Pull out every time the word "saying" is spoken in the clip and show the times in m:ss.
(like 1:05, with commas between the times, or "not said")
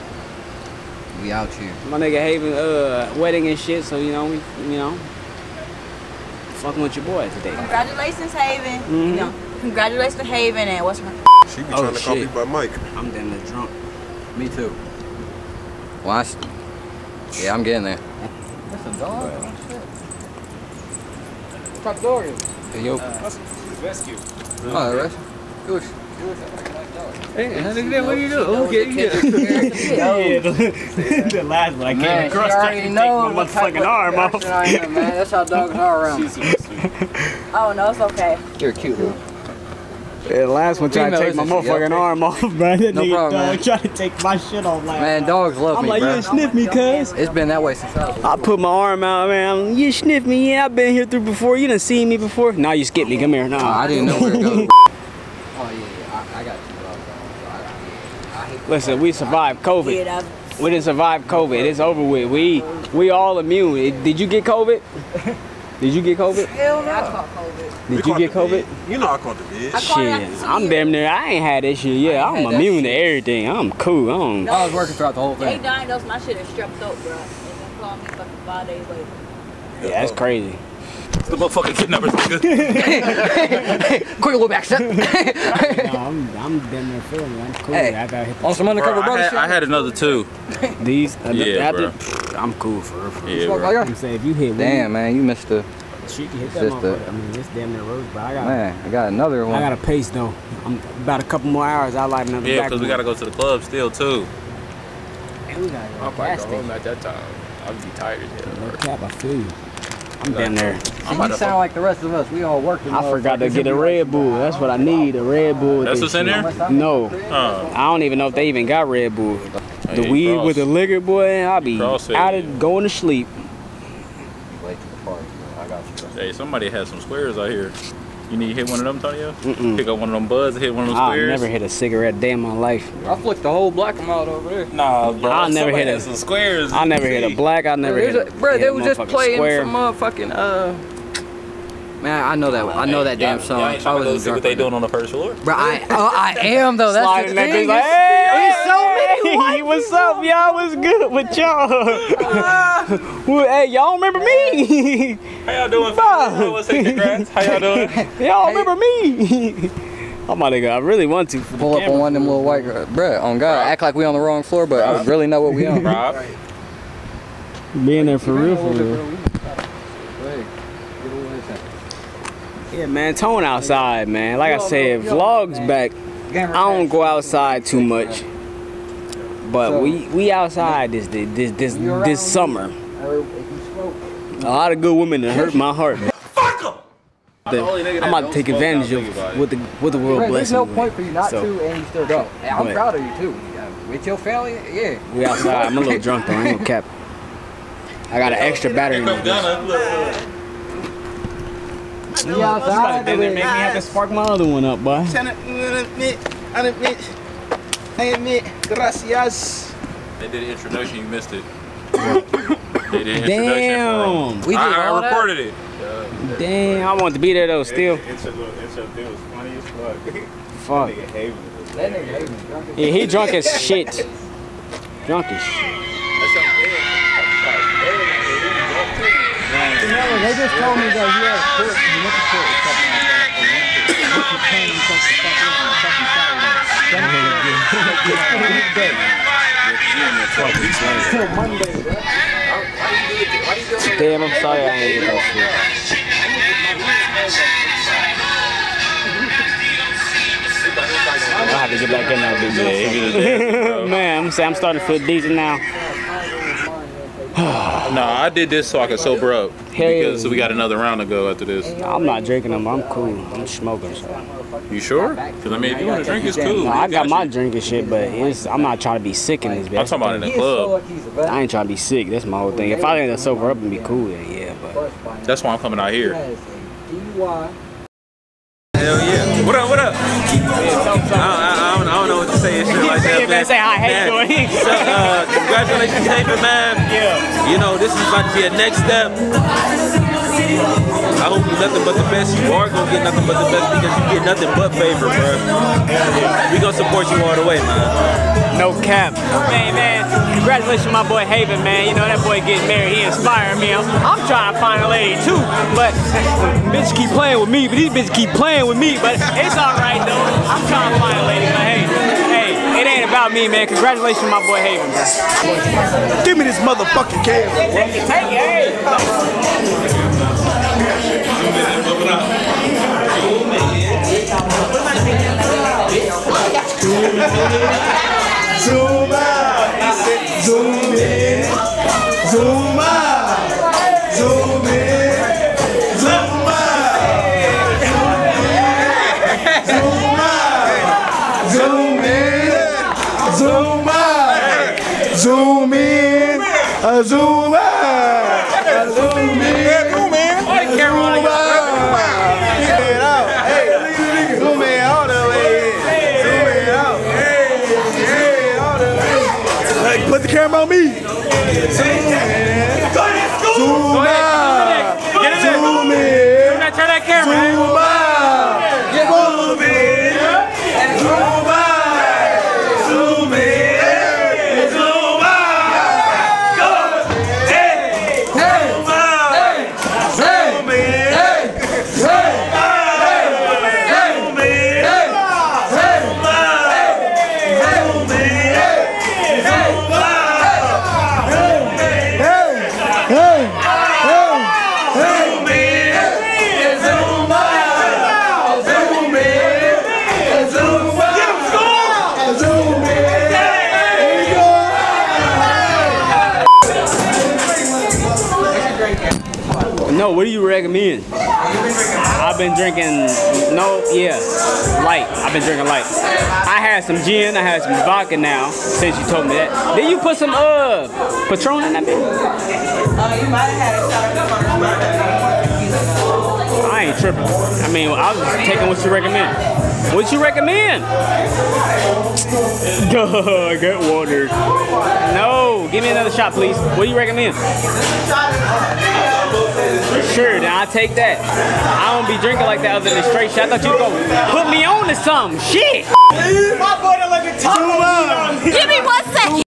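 1:33, 4:14.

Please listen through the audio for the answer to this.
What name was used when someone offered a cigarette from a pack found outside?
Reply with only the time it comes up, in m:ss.
2:08.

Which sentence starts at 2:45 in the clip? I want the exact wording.
Bro, Being there for real, for real.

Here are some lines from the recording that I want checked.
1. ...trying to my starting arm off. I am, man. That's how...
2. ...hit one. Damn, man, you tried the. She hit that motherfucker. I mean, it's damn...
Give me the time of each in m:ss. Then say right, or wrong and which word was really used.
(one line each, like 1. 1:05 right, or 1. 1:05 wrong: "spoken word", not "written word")
1. 0:32 wrong: "motherfucking", not "starting"
2. 1:34 wrong: "missed", not "tried".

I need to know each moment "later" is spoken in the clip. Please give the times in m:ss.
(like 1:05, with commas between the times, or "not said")
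1:18.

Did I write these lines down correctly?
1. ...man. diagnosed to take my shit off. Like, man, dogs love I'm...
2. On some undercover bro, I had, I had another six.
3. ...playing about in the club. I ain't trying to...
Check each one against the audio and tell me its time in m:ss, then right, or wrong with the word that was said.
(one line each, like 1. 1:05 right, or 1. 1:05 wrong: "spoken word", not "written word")
1. 0:43 wrong: "tried", not "diagnosed"
2. 1:28 wrong: "two", not "six"
3. 4:29 wrong: "talking", not "playing".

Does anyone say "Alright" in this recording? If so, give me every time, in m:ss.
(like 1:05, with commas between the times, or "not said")
0:24.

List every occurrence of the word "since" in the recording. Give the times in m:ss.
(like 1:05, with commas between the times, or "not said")
0:47, 6:58.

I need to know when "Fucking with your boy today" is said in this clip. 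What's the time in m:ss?
0:06.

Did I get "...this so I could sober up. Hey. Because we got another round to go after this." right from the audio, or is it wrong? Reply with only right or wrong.
right.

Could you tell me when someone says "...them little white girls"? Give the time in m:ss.
2:42.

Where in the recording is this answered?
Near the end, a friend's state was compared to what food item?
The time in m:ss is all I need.
7:27.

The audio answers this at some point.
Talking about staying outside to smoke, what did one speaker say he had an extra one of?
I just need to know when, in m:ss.
3:18.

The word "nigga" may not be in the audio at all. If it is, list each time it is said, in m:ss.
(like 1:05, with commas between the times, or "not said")
0:01, 0:43, 1:22.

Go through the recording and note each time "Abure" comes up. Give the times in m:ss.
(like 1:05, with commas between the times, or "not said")
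not said.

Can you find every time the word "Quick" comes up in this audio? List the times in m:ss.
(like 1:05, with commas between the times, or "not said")
1:24.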